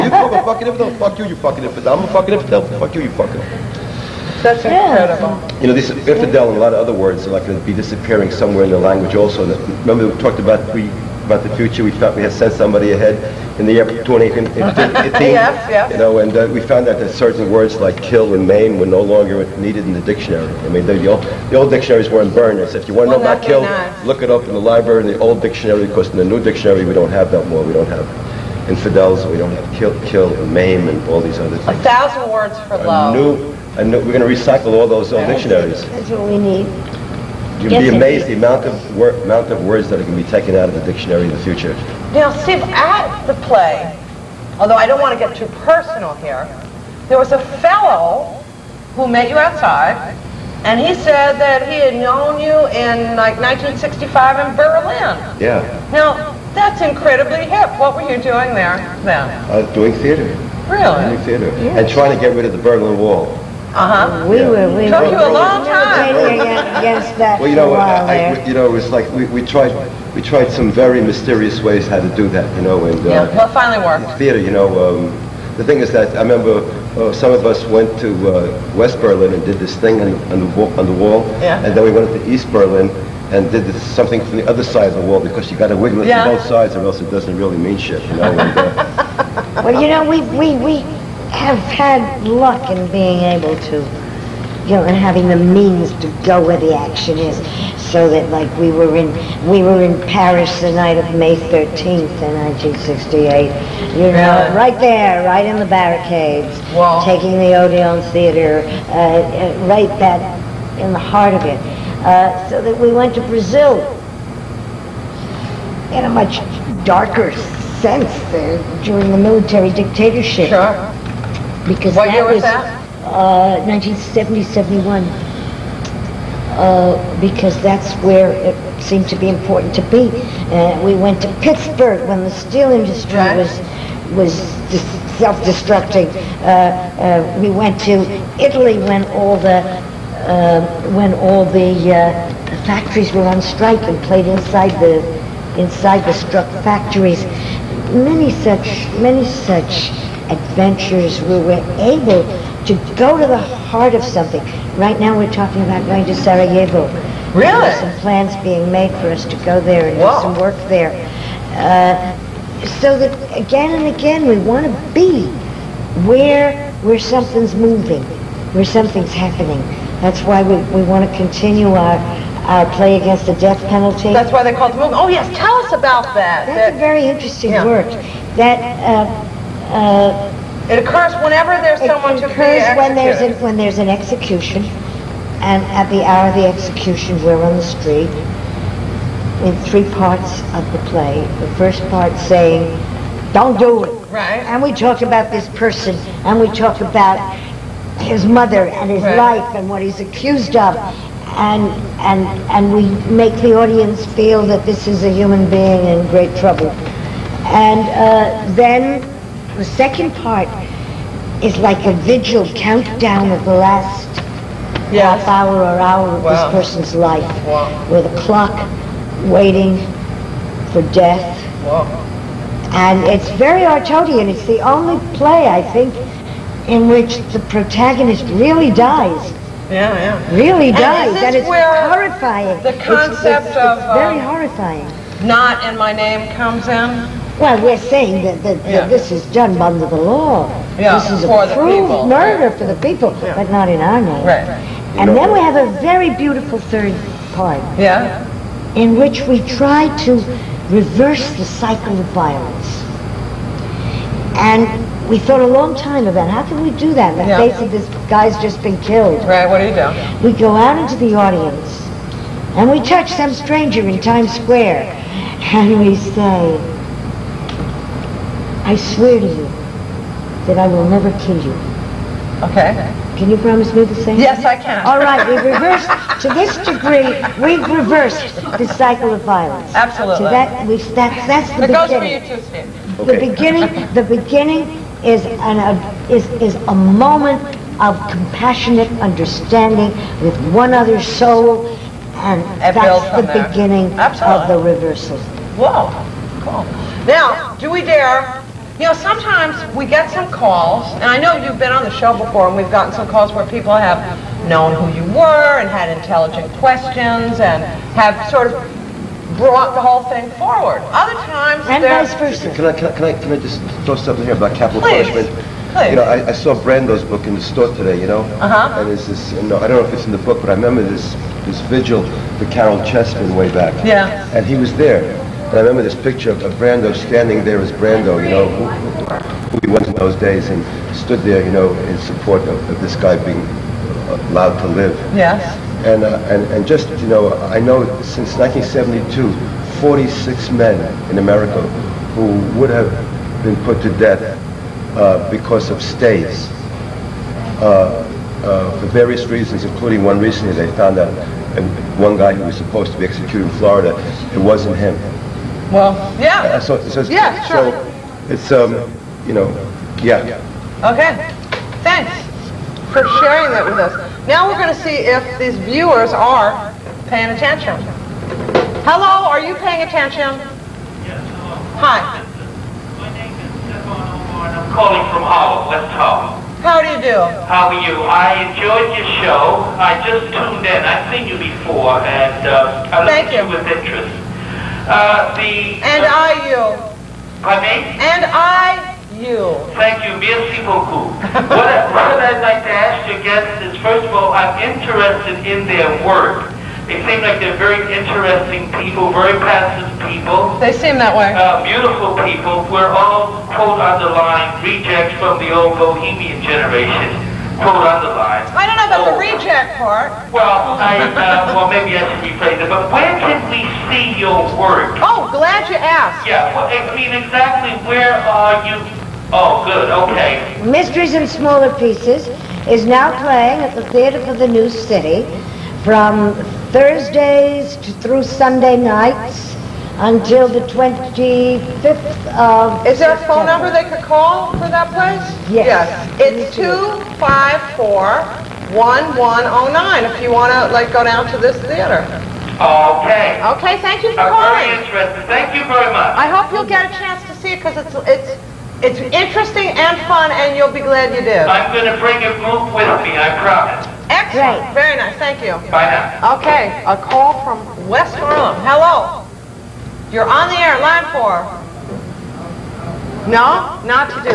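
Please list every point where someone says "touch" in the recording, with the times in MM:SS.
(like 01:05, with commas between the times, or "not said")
04:22.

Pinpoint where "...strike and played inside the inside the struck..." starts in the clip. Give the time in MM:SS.
02:23.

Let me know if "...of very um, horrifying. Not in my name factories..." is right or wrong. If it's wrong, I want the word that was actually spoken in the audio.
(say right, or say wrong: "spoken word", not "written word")
wrong: "comes", not "factories".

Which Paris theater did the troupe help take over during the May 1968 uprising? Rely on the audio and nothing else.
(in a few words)
Odeon Theater.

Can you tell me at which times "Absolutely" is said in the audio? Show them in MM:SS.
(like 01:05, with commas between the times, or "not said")
04:39, 04:53.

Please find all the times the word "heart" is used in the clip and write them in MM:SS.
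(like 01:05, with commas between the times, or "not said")
01:50, 02:33.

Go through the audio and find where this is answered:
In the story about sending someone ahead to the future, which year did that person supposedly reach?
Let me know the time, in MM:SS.
00:14.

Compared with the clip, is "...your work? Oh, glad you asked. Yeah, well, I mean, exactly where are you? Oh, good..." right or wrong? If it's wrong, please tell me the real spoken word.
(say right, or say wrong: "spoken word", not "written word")
right.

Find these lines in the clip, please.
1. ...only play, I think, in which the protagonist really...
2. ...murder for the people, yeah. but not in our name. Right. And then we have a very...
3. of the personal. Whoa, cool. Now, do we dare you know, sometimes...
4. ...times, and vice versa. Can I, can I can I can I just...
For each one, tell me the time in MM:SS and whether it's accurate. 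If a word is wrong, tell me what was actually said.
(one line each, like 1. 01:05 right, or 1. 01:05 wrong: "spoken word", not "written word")
1. 03:44 right
2. 04:02 right
3. 04:54 wrong: "reversal", not "personal"
4. 05:11 right.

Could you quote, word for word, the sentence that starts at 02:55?
Oh yes, tell us about that.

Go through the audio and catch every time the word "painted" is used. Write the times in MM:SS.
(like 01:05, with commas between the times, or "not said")
not said.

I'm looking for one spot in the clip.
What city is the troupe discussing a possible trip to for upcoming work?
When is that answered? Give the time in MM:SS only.
02:36.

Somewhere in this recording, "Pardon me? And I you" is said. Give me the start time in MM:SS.
06:27.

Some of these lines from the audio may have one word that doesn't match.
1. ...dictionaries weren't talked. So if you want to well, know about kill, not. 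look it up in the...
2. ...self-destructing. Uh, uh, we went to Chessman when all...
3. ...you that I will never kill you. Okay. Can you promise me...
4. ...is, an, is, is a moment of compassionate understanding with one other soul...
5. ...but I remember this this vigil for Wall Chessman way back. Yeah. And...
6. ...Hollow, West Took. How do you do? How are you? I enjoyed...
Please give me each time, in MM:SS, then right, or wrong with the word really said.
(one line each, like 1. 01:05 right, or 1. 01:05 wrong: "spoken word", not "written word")
1. 00:21 wrong: "burned", not "talked"
2. 02:15 wrong: "Italy", not "Chessman"
3. 04:29 right
4. 04:45 right
5. 05:20 wrong: "Caryl", not "Wall"
6. 06:15 wrong: "Hollow", not "Took".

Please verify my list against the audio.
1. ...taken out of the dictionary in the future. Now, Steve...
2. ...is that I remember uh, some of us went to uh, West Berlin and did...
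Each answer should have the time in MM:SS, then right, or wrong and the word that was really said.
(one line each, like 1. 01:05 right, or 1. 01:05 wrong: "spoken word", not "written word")
1. 00:40 right
2. 01:15 right.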